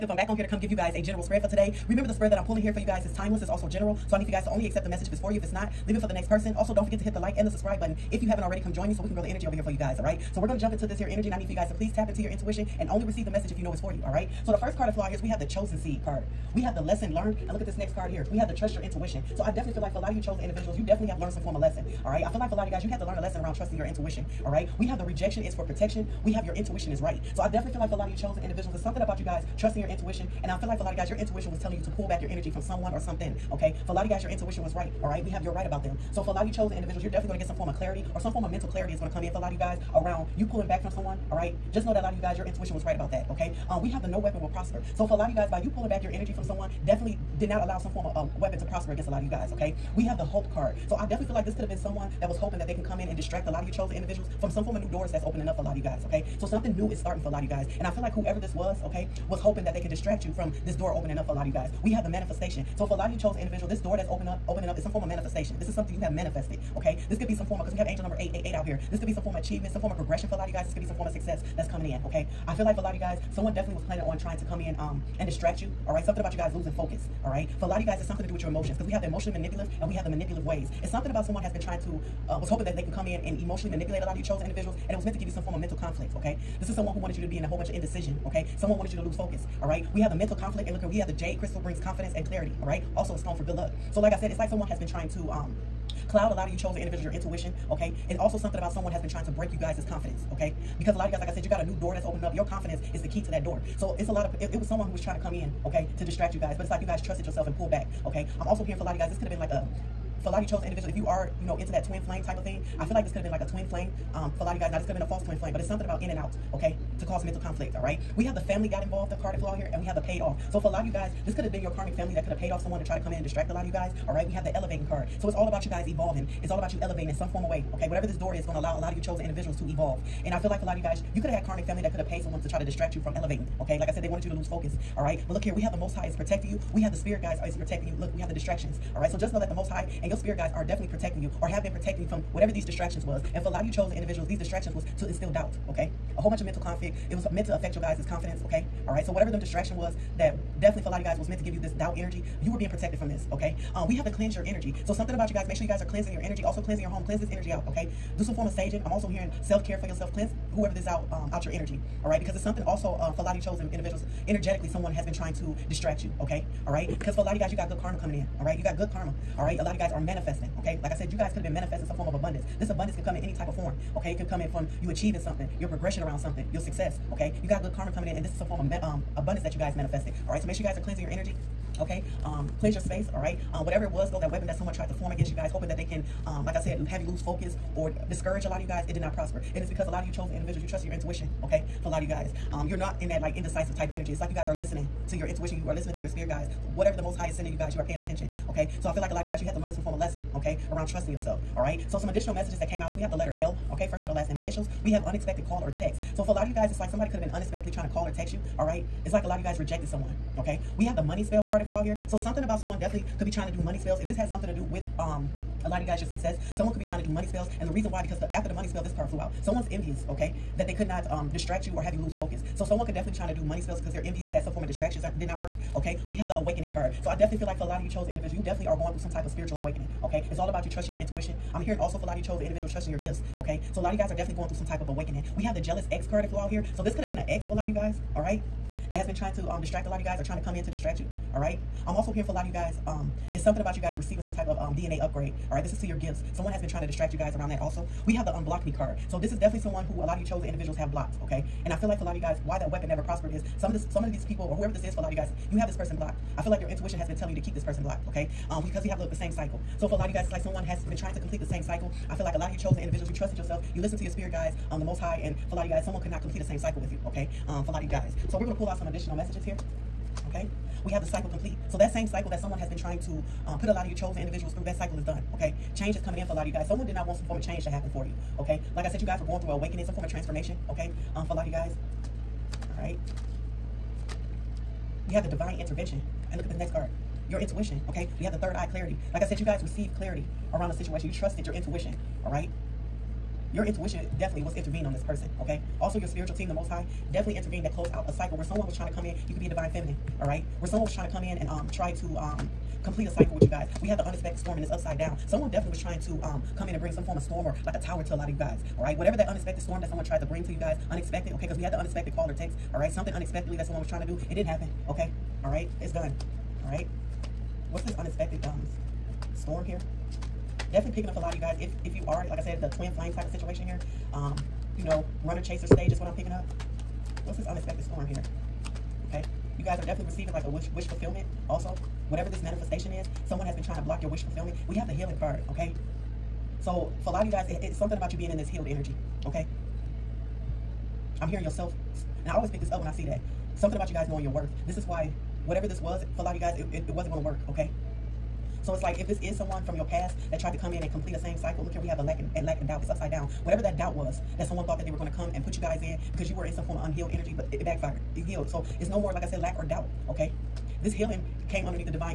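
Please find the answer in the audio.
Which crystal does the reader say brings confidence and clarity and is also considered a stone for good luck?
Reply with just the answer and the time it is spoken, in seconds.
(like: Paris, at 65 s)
Jade, at 91 s.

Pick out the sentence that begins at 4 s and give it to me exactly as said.
So I need you guys to only accept the message if it's for you.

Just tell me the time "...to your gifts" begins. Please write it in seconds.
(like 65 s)
245 s.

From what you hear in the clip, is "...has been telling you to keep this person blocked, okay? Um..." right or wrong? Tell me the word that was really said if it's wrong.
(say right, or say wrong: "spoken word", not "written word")
right.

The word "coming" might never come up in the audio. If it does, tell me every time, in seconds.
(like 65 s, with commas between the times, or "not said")
71 s, 167 s, 177 s, 276 s.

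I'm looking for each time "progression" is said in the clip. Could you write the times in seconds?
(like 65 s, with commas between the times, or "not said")
69 s, 175 s.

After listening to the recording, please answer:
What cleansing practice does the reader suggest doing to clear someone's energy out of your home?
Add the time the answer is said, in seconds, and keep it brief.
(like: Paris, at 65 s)
Saging, at 158 s.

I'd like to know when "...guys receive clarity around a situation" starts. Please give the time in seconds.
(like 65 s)
289 s.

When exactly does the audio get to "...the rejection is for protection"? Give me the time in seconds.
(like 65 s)
24 s.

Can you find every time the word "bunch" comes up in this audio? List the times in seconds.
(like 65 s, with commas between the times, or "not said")
87 s, 146 s.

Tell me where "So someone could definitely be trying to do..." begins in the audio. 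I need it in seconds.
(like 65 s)
222 s.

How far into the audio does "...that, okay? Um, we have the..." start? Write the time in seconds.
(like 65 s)
43 s.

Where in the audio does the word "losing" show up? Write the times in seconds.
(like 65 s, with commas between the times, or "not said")
76 s.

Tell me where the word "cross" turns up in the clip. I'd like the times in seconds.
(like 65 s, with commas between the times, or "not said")
not said.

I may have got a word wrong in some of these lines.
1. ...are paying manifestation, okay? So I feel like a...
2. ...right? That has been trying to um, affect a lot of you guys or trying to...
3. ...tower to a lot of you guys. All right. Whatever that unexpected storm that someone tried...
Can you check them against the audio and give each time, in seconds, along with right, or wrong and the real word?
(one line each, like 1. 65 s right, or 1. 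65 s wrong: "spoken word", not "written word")
1. 197 s wrong: "attention", not "manifestation"
2. 238 s wrong: "distract", not "affect"
3. 307 s right.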